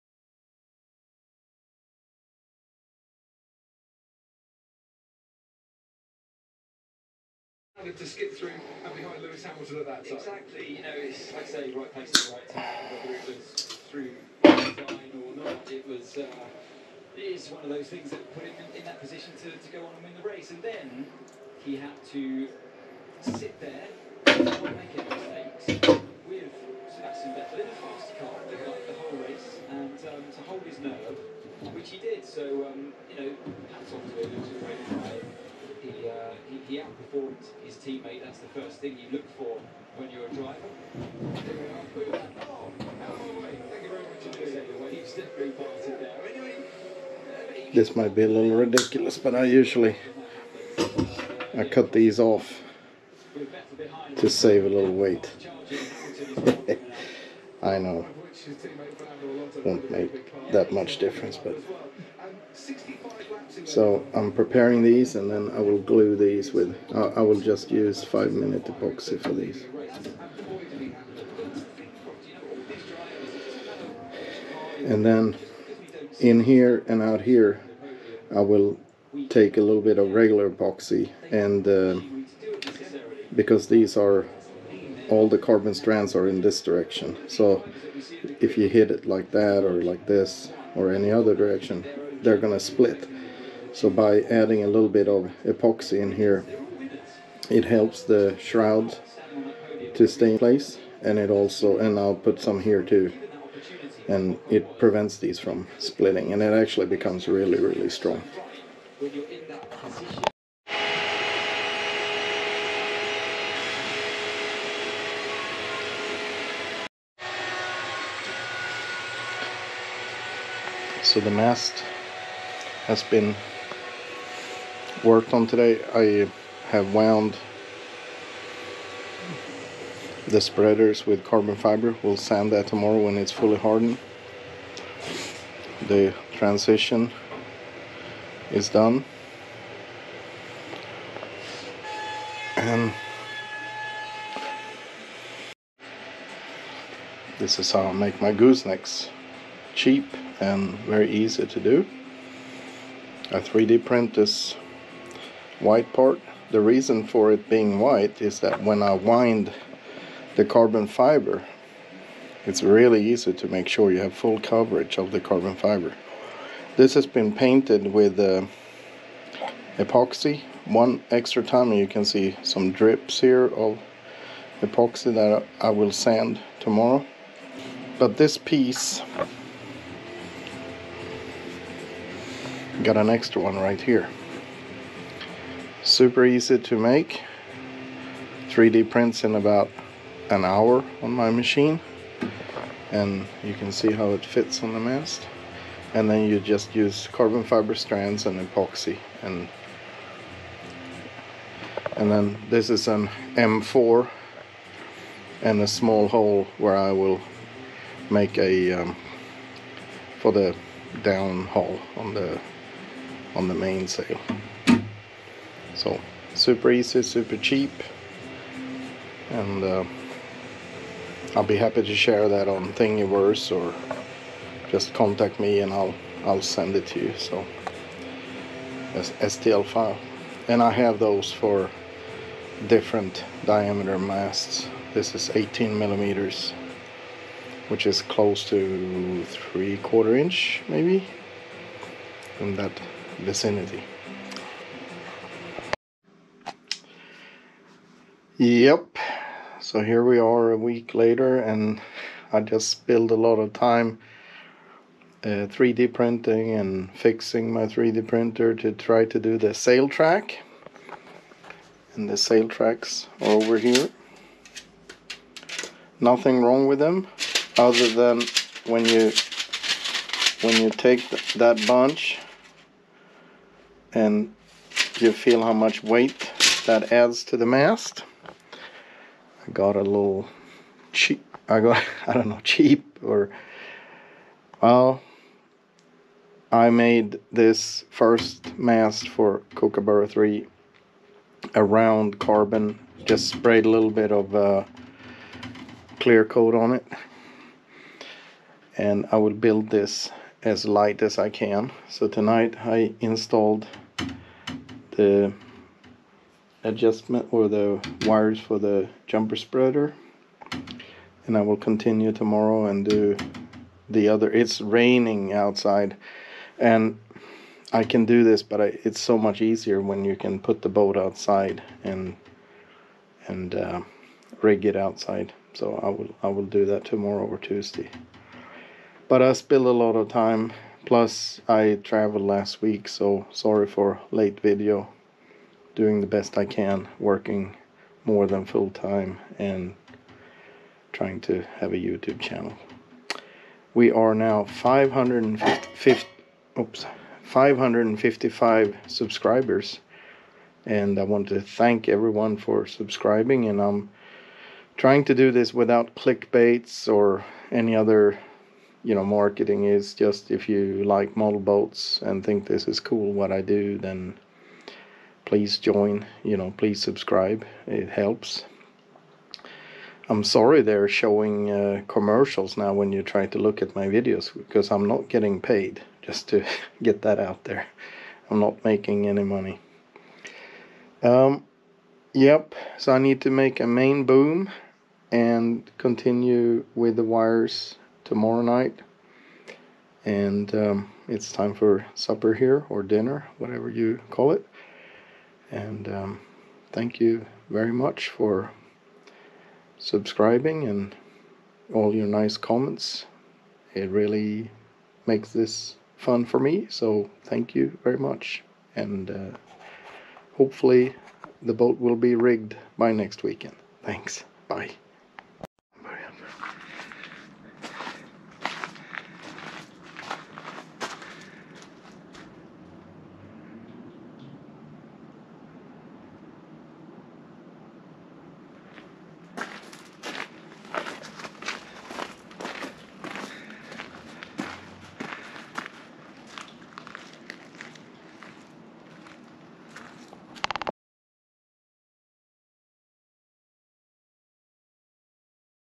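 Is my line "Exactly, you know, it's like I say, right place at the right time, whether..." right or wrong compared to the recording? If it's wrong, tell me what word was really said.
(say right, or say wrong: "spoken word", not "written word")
right.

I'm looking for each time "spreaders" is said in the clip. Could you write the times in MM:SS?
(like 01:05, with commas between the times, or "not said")
02:10, 05:09.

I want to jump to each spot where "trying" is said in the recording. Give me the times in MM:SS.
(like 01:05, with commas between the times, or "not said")
05:40, 05:54.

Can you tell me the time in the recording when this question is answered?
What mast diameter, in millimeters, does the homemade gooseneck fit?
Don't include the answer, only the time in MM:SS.
03:55.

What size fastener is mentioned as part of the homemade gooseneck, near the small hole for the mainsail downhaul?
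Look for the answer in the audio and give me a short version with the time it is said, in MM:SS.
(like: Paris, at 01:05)
M4, at 03:23.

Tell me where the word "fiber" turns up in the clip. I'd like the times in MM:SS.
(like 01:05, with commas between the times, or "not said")
02:11, 02:40, 02:45, 03:17.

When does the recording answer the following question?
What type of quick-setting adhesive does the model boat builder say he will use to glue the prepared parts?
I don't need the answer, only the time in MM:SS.
01:08.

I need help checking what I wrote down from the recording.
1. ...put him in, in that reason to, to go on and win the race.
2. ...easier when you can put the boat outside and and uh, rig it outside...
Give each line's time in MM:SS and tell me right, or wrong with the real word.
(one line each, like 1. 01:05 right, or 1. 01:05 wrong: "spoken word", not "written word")
1. 00:18 wrong: "position", not "reason"
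2. 05:19 right.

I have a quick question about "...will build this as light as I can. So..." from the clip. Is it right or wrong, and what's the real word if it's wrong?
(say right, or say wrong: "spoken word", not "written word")
right.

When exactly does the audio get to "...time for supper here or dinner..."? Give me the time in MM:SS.
06:31.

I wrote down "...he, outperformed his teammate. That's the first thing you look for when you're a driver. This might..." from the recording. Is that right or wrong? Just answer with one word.
right.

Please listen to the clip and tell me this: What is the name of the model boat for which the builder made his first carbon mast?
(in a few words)
Kookaburra 3.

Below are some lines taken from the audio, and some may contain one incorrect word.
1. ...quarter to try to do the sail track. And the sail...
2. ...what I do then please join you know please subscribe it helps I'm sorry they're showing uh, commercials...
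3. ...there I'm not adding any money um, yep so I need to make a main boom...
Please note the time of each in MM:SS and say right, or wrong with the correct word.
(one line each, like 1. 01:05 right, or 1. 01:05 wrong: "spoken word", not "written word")
1. 04:18 wrong: "printer", not "quarter"
2. 06:03 right
3. 06:17 wrong: "making", not "adding".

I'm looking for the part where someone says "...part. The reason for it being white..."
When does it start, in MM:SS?
02:35.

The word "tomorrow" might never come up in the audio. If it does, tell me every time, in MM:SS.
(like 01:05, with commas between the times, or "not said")
02:12, 02:56, 05:12, 05:26, 06:28.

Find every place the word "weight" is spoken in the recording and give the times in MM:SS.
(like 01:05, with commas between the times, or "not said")
00:54, 04:35.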